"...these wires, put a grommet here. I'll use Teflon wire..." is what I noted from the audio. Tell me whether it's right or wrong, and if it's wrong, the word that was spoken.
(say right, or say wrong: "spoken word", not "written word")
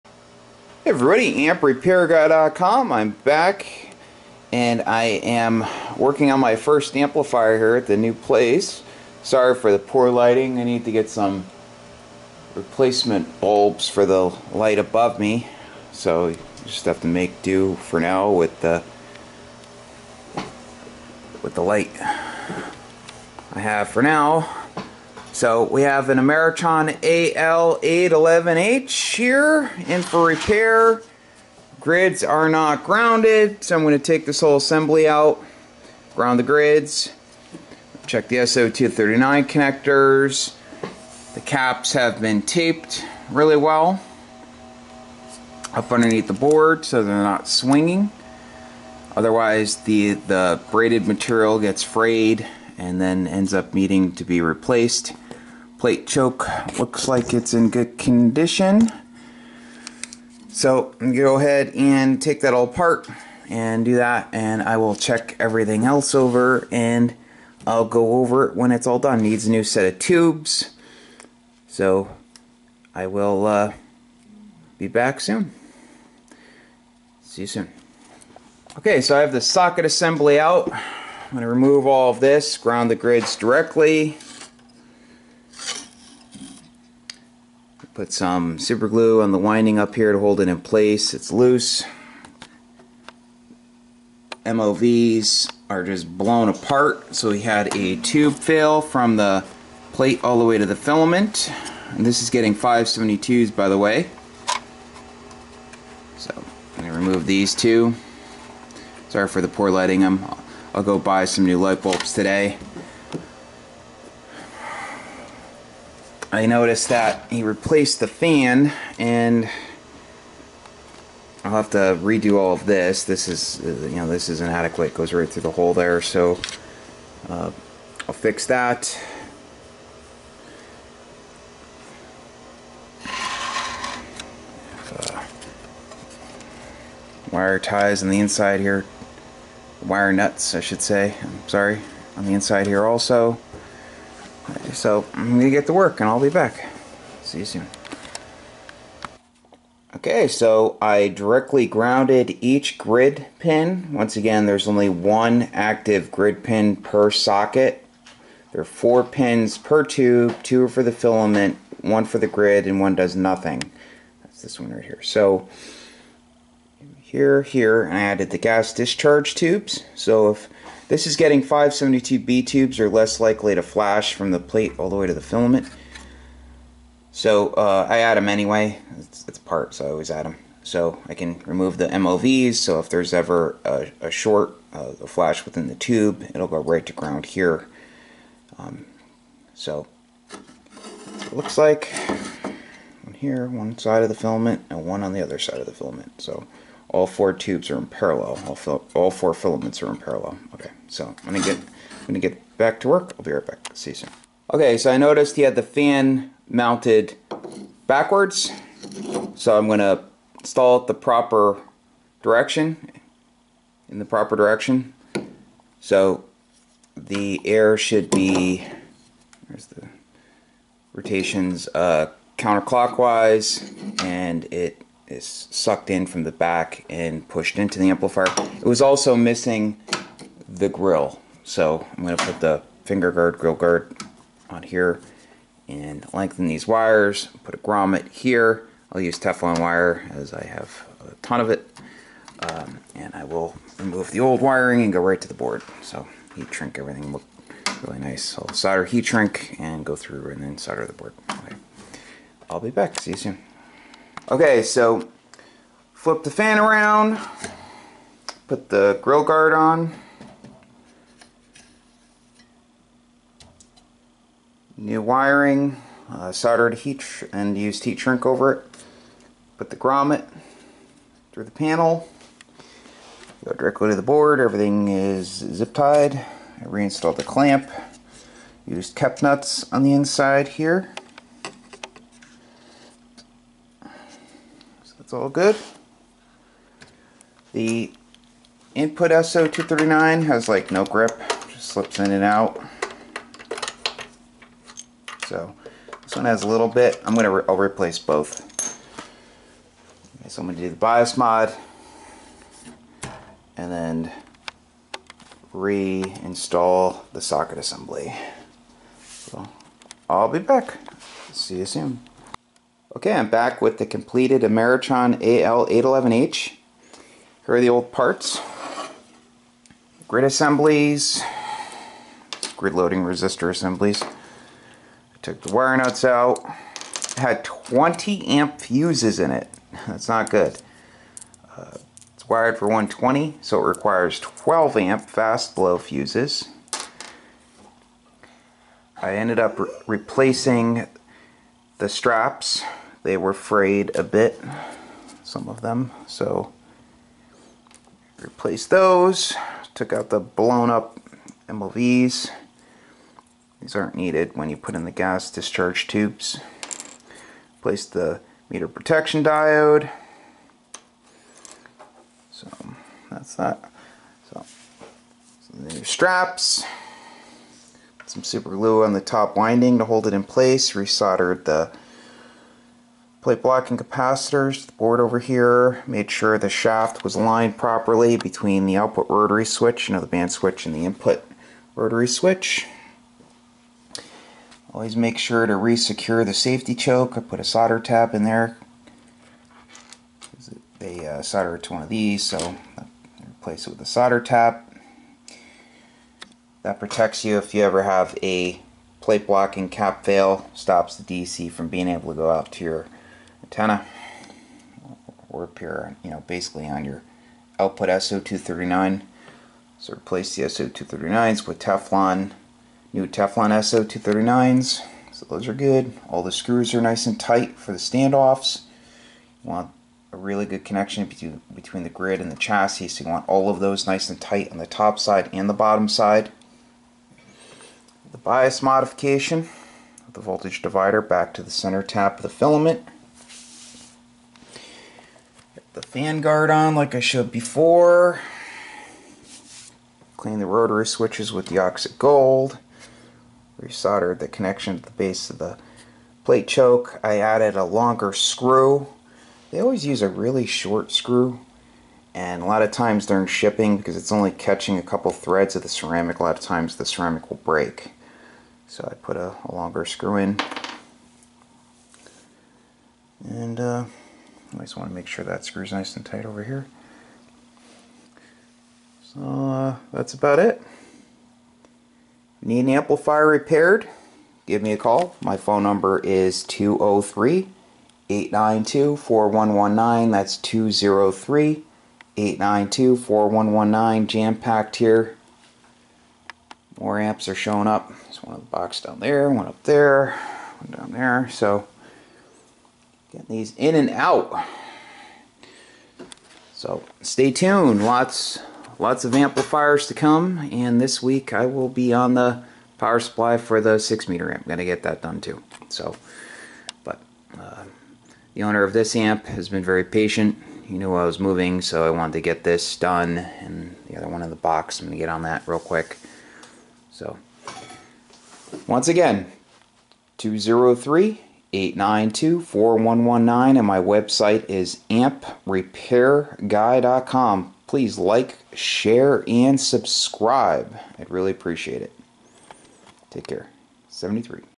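right.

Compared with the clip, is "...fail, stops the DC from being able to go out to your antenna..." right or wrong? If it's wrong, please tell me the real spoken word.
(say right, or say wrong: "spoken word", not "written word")
right.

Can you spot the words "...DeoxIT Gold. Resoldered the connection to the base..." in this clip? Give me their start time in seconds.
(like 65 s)
441 s.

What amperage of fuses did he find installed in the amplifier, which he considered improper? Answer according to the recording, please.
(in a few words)
20 amp.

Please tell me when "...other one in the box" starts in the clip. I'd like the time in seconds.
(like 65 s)
513 s.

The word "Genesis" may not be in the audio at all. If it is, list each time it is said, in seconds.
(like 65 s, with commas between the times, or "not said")
not said.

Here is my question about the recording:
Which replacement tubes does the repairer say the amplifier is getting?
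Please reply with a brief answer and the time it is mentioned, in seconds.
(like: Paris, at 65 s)
572s, at 102 s.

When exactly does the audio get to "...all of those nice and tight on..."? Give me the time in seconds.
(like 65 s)
423 s.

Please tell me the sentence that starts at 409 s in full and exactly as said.
So replace the SO239s with Teflon, new Teflon SO239s.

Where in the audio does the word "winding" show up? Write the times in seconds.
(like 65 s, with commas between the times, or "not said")
89 s, 369 s.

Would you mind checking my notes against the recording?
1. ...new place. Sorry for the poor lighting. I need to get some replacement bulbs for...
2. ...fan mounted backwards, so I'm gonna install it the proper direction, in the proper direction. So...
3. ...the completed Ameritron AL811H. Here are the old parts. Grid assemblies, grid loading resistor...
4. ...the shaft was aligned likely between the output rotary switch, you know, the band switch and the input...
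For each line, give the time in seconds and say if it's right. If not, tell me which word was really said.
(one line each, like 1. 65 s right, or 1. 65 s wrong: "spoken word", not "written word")
1. 7 s right
2. 205 s right
3. 313 s right
4. 376 s wrong: "properly", not "likely".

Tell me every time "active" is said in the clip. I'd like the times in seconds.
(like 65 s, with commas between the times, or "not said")
155 s.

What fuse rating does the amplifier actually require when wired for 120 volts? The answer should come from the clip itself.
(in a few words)
12 amp fast blow.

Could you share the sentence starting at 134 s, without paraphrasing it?
Uh, wire ties on the inside here.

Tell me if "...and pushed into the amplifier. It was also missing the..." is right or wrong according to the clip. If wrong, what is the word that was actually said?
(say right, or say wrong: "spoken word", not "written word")
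right.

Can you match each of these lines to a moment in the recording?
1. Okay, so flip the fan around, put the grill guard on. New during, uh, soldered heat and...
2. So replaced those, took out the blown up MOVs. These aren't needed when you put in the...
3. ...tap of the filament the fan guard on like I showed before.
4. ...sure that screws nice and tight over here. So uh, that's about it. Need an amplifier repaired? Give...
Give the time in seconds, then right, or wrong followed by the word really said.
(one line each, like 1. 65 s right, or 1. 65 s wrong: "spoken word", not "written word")
1. 254 s wrong: "wiring", not "during"
2. 346 s right
3. 431 s right
4. 465 s right.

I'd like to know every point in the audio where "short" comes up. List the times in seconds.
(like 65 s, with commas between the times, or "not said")
184 s, 450 s.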